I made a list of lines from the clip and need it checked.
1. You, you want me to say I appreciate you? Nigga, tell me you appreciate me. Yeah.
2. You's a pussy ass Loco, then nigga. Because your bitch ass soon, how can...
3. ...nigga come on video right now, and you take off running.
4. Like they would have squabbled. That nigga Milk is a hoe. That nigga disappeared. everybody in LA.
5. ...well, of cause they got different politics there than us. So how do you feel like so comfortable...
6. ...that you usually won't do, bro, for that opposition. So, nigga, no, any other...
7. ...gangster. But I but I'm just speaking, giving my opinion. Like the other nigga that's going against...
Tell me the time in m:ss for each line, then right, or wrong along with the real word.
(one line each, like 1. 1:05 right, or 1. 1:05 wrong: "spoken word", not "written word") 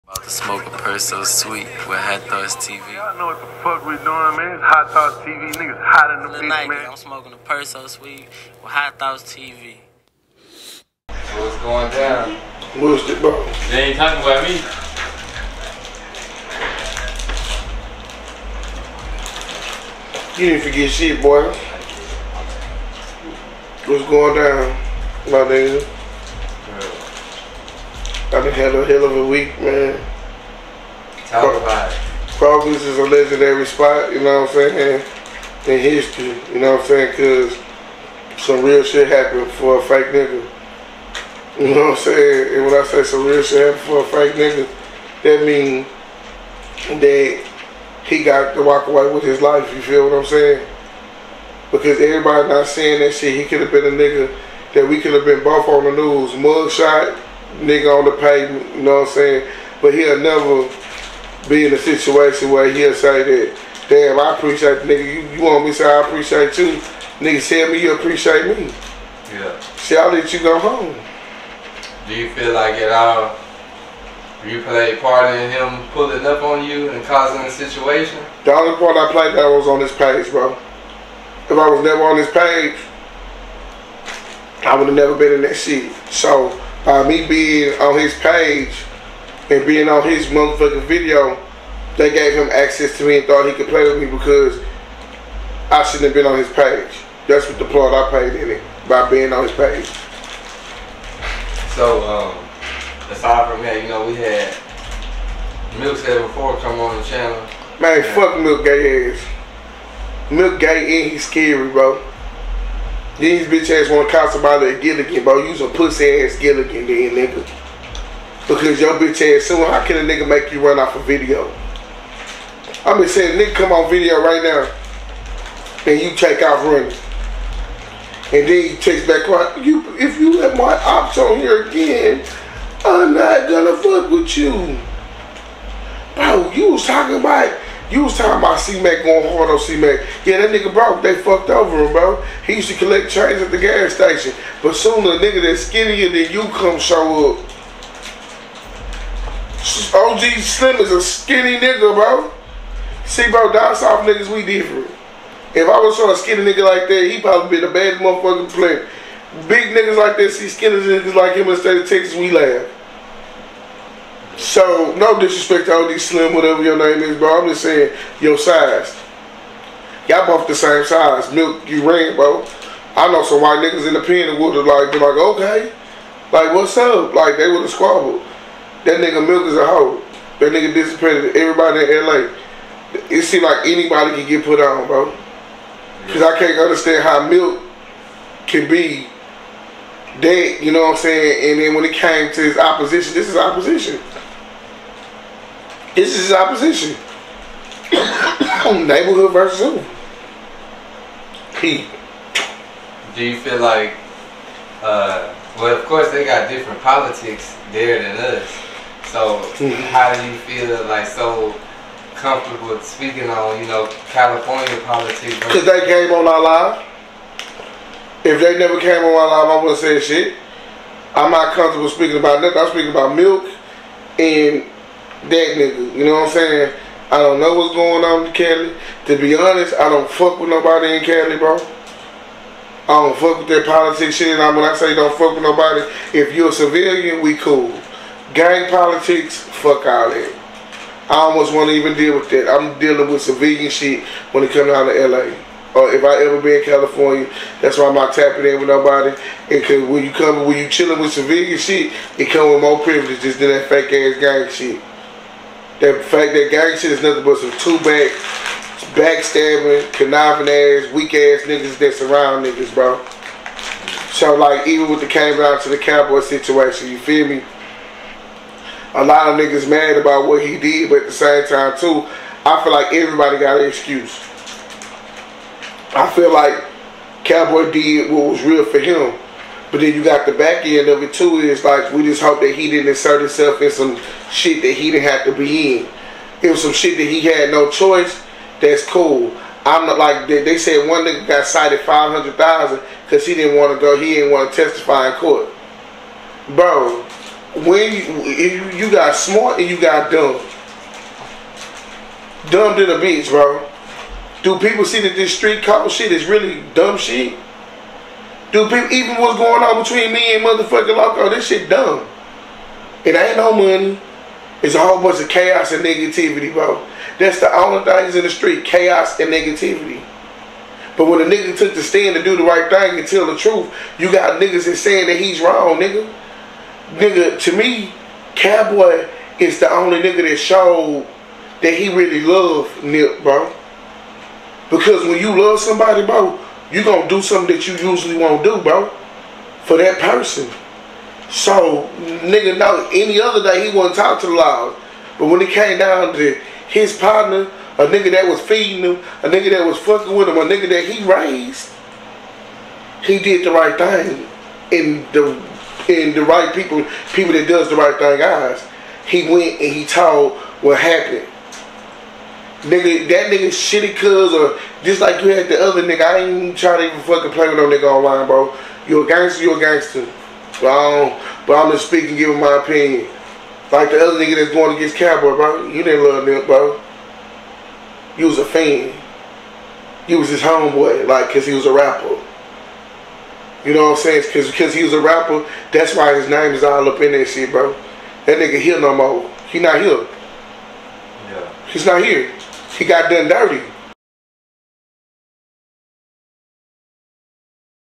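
1. 1:05 right
2. 1:55 wrong: "Gilligan", not "Loco"
3. 2:03 right
4. 2:57 right
5. 3:25 wrong: "course", not "cause"
6. 5:37 wrong: "person", not "opposition"
7. 6:09 right.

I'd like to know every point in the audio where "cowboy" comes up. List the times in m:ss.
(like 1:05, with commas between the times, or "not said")
4:25, 4:37, 5:28, 6:14.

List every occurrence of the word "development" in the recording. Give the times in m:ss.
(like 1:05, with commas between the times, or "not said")
not said.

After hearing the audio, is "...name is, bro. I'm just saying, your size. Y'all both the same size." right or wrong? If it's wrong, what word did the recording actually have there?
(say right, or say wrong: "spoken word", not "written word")
right.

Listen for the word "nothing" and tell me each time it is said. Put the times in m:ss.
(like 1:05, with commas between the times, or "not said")
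3:42, 4:17.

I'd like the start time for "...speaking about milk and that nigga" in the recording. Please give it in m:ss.
3:42.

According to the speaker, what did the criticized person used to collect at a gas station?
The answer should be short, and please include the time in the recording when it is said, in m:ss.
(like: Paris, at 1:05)
change, at 2:22.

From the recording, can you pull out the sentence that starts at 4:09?
And cause when you come, when you chilling with vegan shit, it come with more privileges than that fake ass gang shit.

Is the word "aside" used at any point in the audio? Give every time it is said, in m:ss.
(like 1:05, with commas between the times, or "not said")
1:43.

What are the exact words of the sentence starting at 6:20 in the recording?
You was his homeboy, like, cause he was a rapper.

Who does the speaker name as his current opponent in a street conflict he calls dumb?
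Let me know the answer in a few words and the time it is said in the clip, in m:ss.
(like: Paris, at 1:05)
Loco, at 5:10.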